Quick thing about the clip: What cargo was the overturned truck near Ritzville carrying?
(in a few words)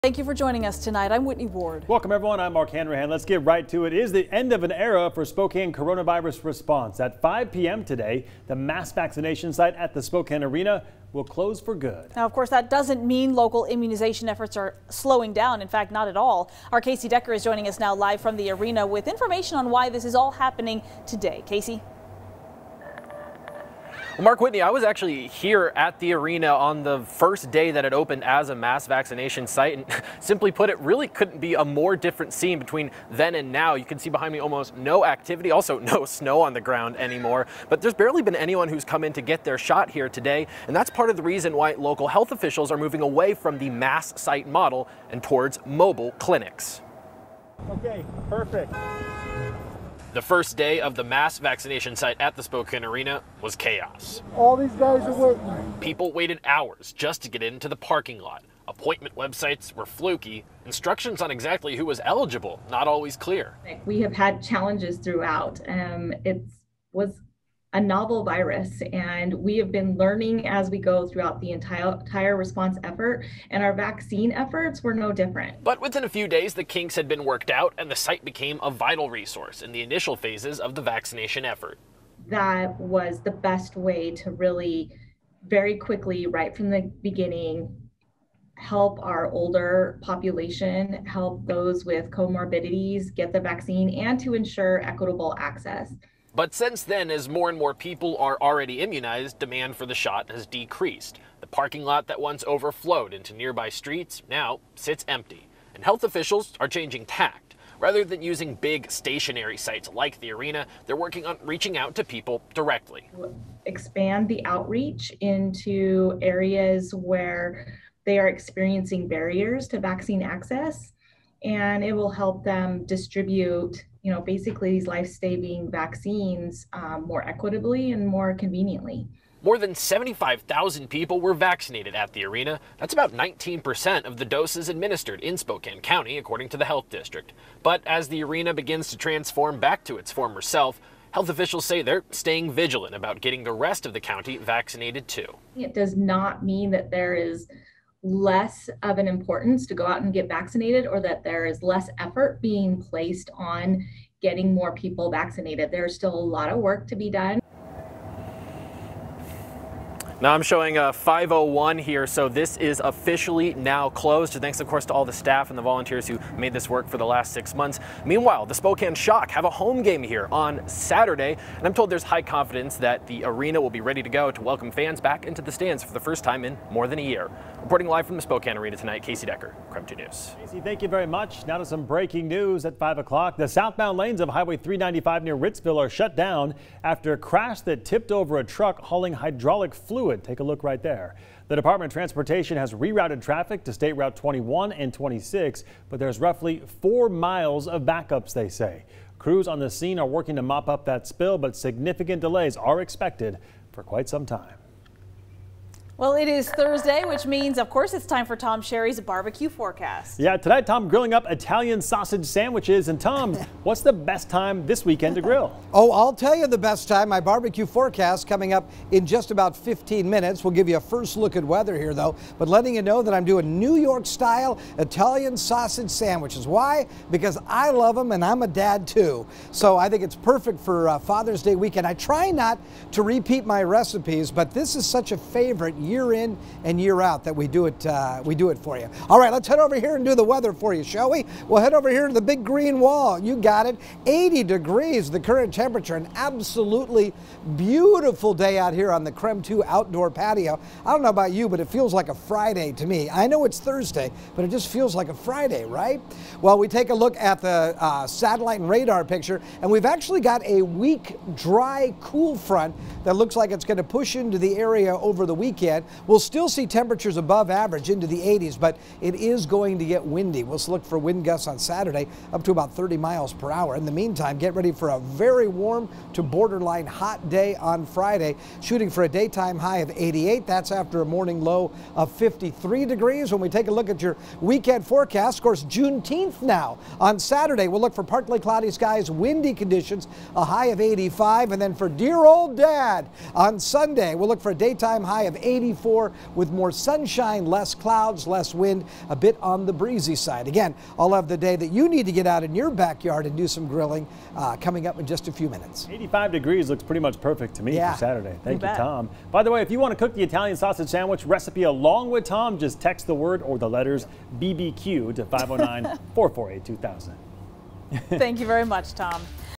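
hydraulic fluid.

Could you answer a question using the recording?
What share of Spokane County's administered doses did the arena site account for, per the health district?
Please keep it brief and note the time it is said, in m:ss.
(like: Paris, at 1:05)
19%, at 2:13.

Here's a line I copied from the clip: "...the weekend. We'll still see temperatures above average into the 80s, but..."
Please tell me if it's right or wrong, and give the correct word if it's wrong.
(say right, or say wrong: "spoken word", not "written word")
right.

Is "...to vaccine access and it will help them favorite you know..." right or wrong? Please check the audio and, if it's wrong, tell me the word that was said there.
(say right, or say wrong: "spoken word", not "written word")
wrong: "distribute", not "favorite".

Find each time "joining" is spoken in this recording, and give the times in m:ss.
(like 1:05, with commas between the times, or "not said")
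0:00, 0:17.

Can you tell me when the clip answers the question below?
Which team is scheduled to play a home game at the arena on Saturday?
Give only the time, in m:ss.
2:48.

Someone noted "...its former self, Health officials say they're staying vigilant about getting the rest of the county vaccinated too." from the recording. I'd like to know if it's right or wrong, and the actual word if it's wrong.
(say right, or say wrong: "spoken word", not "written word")
right.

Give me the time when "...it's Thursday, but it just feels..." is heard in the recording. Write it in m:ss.
4:13.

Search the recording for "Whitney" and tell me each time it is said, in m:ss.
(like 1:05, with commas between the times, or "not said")
0:01, 0:24.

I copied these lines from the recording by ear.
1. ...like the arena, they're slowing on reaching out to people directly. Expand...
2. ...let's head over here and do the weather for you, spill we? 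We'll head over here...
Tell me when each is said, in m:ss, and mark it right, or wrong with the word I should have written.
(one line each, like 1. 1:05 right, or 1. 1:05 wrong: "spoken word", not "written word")
1. 1:49 wrong: "working", not "slowing"
2. 3:59 wrong: "shall", not "spill".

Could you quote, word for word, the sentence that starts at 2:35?
There's still a lot of work to be done.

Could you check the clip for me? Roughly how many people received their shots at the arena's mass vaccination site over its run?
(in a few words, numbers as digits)
75,000.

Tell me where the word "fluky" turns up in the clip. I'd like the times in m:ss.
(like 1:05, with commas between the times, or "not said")
0:59.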